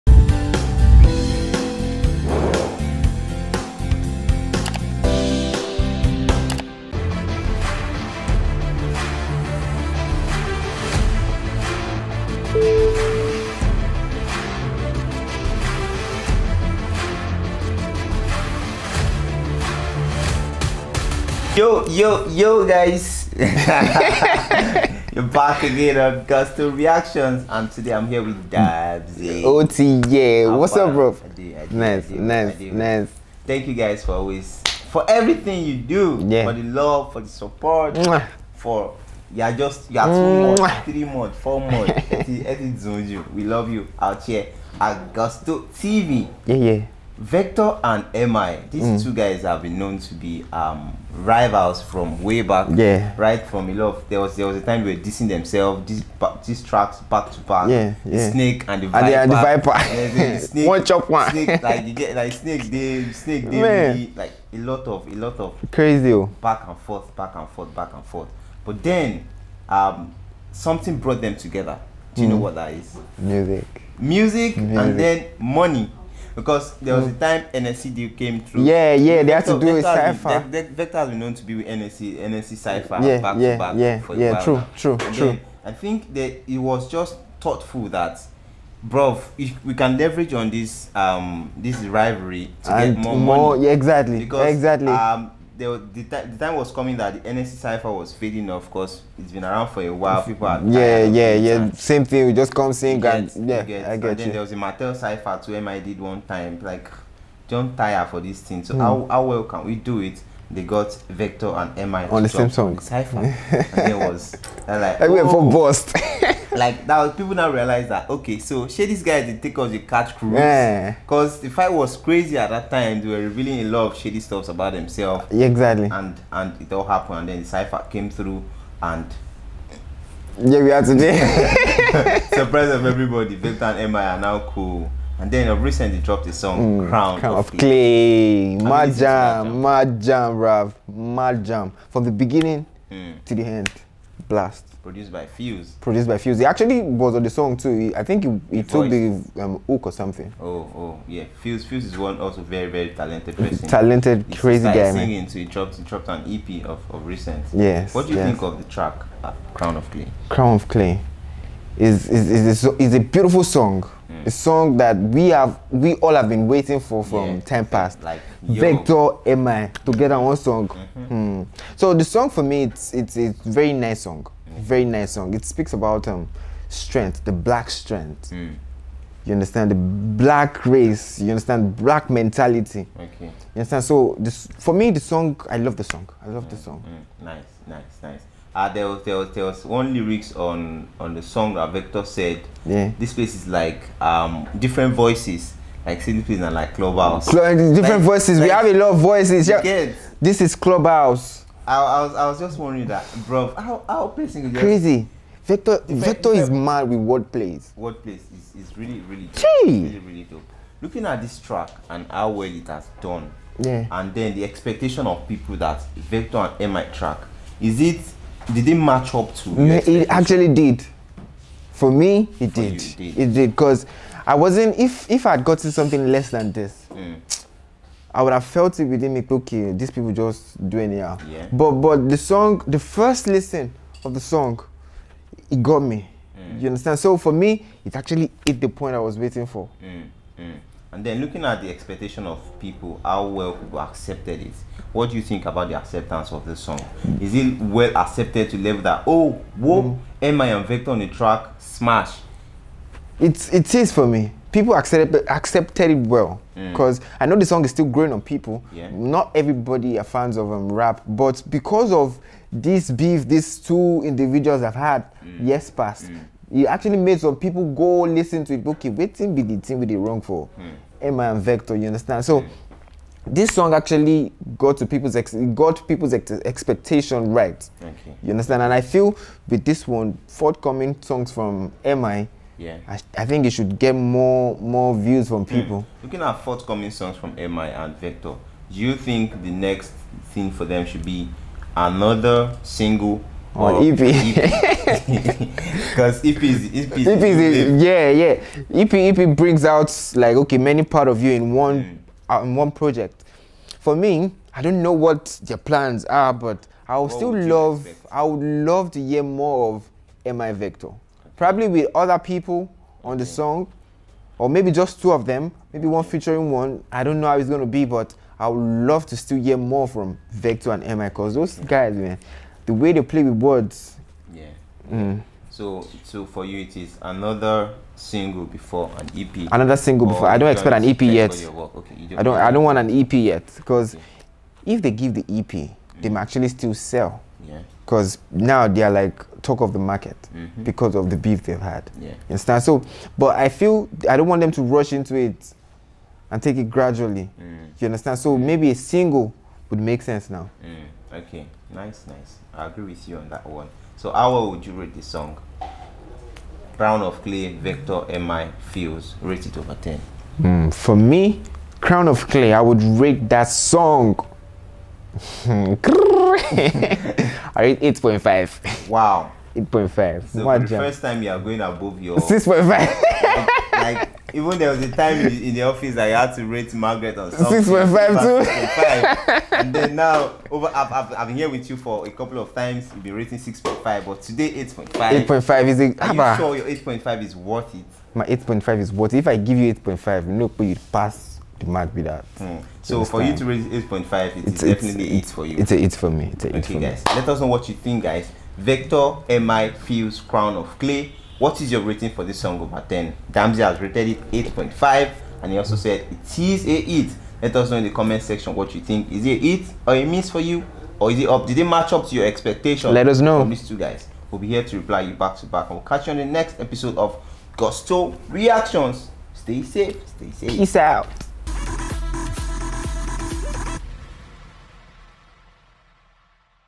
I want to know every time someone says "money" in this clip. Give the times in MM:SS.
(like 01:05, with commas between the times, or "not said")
01:15, 01:33.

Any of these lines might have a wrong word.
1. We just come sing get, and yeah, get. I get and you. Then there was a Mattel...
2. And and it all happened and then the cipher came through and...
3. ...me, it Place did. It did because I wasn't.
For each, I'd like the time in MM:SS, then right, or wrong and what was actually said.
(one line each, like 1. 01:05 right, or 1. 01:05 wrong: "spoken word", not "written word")
1. 01:42 right
2. 02:05 right
3. 03:41 wrong: "For", not "Place".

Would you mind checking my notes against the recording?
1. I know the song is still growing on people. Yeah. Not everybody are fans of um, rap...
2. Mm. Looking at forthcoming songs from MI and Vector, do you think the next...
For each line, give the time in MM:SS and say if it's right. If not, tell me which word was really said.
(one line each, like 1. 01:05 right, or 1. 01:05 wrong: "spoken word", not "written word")
1. 04:17 right
2. 04:45 right.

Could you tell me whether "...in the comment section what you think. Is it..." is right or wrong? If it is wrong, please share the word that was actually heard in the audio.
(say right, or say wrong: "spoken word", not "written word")
right.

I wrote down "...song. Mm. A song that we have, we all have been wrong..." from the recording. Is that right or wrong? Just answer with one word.
wrong.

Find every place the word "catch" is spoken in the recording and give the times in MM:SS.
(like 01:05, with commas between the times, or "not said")
01:59, 06:55.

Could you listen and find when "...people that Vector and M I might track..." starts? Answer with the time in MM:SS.
03:35.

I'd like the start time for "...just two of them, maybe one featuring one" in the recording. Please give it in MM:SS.
05:14.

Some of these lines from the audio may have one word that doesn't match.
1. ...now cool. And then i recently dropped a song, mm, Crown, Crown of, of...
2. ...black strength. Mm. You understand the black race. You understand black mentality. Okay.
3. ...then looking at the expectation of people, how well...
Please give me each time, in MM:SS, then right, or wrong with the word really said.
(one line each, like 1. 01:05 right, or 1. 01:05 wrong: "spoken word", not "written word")
1. 02:14 right
2. 02:57 right
3. 04:01 right.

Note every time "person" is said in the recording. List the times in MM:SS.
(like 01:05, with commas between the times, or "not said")
02:33, 03:24.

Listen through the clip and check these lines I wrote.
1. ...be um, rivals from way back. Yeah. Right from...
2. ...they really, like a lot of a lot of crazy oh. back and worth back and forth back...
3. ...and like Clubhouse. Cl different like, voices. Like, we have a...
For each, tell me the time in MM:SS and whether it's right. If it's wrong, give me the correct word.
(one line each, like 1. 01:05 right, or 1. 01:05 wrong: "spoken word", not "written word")
1. 00:50 right
2. 01:03 wrong: "forth", not "worth"
3. 03:16 right.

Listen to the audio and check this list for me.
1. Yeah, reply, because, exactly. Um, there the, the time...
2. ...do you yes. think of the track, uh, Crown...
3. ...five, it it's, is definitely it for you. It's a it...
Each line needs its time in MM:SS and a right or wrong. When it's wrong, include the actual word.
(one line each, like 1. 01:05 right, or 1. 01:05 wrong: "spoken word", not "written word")
1. 01:33 wrong: "exactly", not "reply"
2. 02:38 right
3. 06:34 right.